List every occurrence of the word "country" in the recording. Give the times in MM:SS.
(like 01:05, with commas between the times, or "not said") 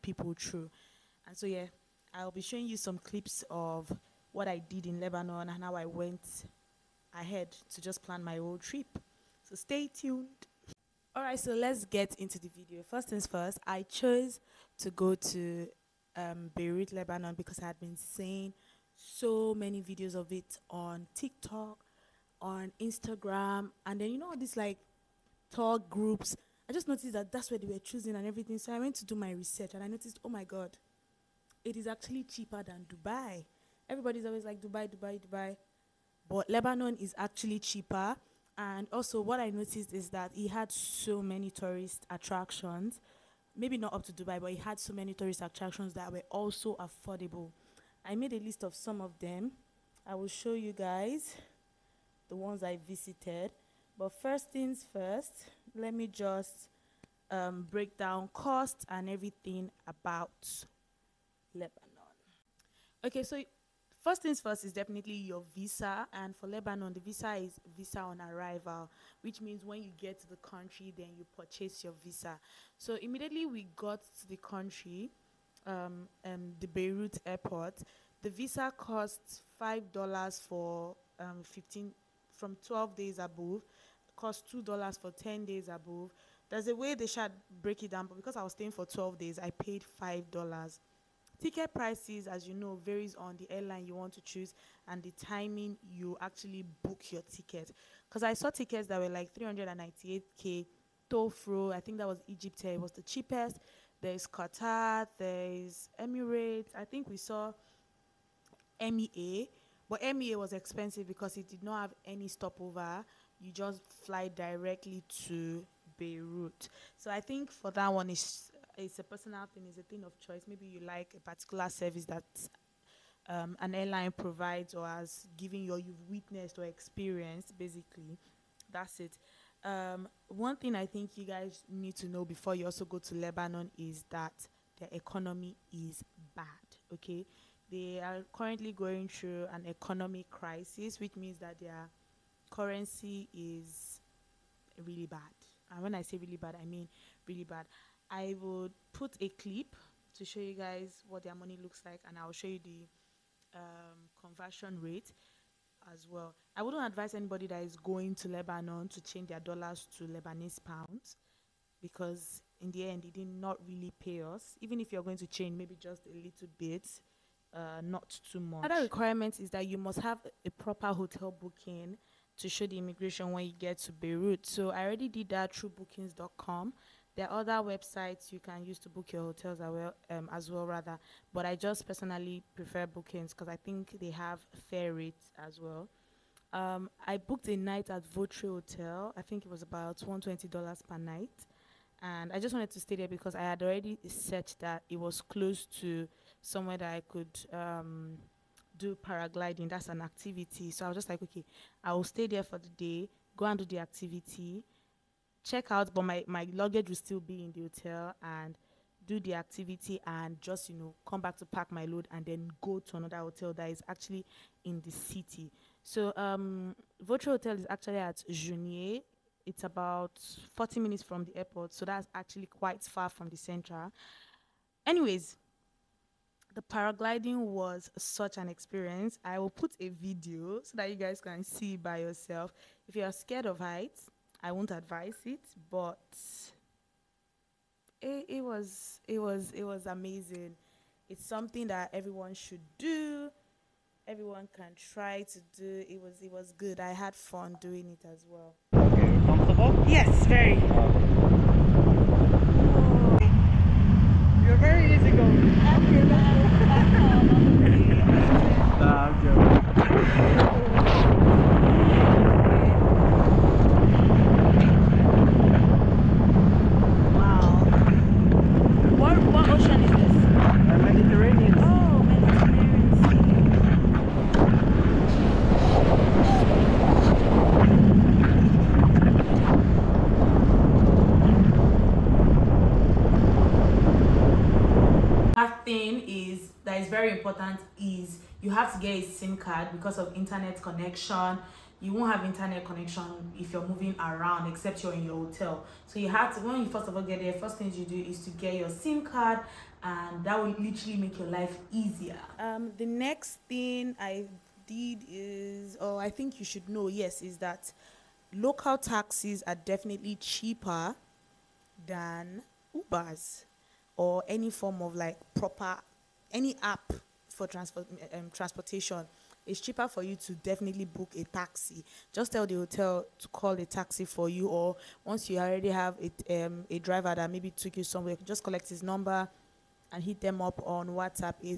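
01:10, 01:14.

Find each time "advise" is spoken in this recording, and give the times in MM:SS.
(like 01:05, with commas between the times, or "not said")
02:36, 03:54.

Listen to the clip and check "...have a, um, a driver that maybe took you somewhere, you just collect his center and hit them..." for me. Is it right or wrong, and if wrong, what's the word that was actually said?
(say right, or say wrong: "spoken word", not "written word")
wrong: "number", not "center".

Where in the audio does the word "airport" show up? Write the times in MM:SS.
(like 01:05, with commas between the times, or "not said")
01:17, 03:41.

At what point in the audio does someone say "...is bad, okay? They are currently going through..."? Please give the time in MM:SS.
02:15.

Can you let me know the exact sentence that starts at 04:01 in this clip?
It's something that everyone should do.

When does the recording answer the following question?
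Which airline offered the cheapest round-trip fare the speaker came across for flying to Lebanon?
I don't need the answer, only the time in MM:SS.
01:42.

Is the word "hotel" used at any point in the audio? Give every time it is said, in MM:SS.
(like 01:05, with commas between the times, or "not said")
02:50, 02:59, 03:08, 03:27, 03:33, 03:37, 04:55, 05:22.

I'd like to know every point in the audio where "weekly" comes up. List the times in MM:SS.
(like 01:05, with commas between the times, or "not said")
not said.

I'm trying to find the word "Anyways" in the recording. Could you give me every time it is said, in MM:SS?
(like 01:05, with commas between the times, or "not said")
03:44.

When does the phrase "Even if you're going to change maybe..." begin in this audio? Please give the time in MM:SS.
02:44.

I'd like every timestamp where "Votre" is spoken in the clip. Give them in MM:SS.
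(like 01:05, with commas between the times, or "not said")
03:08, 03:37.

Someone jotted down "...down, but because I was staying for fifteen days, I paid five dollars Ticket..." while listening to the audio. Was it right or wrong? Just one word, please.
wrong.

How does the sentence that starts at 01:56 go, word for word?
So I think for that one, it's it's a personal thing, it's a thing of choice.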